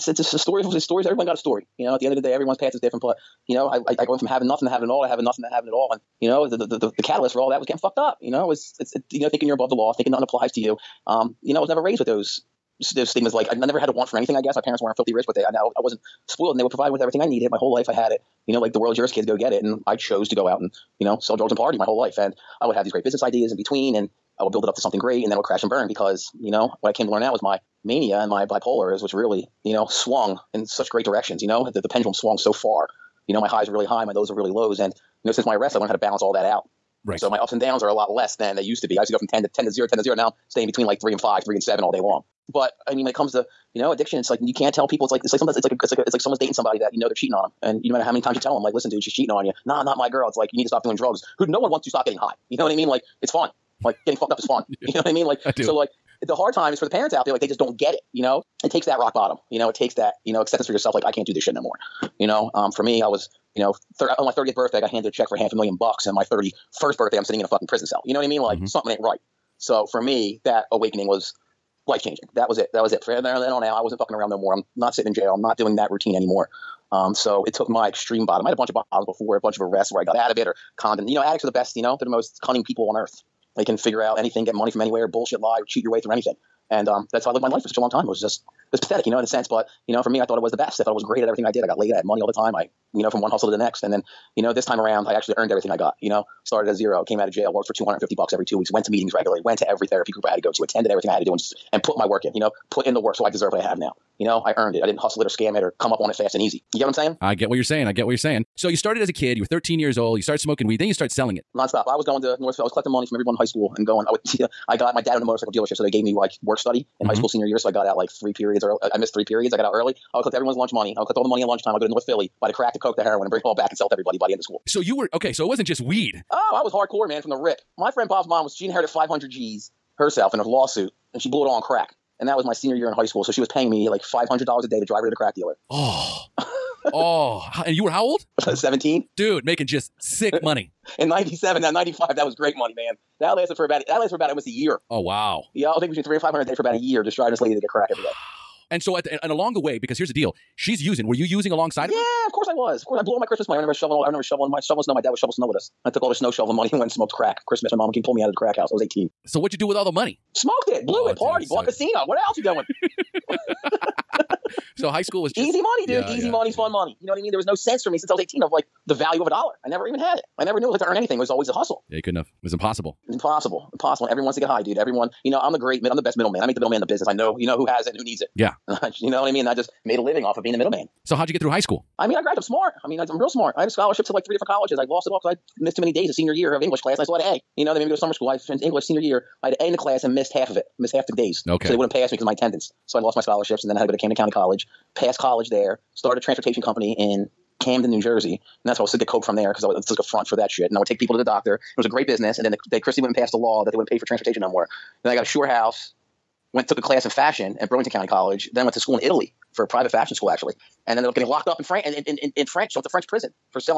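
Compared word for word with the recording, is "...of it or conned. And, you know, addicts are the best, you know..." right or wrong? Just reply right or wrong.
right.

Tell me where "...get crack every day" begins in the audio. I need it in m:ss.
2:27.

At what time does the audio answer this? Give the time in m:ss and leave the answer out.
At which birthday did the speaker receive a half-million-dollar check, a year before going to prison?
1:04.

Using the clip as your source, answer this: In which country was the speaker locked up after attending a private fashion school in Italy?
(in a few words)
France.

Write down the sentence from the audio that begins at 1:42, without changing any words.
You know, put in the work so I deserve what I have now.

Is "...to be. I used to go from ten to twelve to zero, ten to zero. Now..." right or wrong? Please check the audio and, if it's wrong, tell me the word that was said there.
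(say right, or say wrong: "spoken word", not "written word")
wrong: "ten", not "twelve".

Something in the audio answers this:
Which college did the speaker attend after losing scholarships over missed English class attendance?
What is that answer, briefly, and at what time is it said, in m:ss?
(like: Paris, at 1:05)
Camden County College, at 3:13.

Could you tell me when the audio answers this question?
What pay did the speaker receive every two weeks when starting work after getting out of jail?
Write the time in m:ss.
1:37.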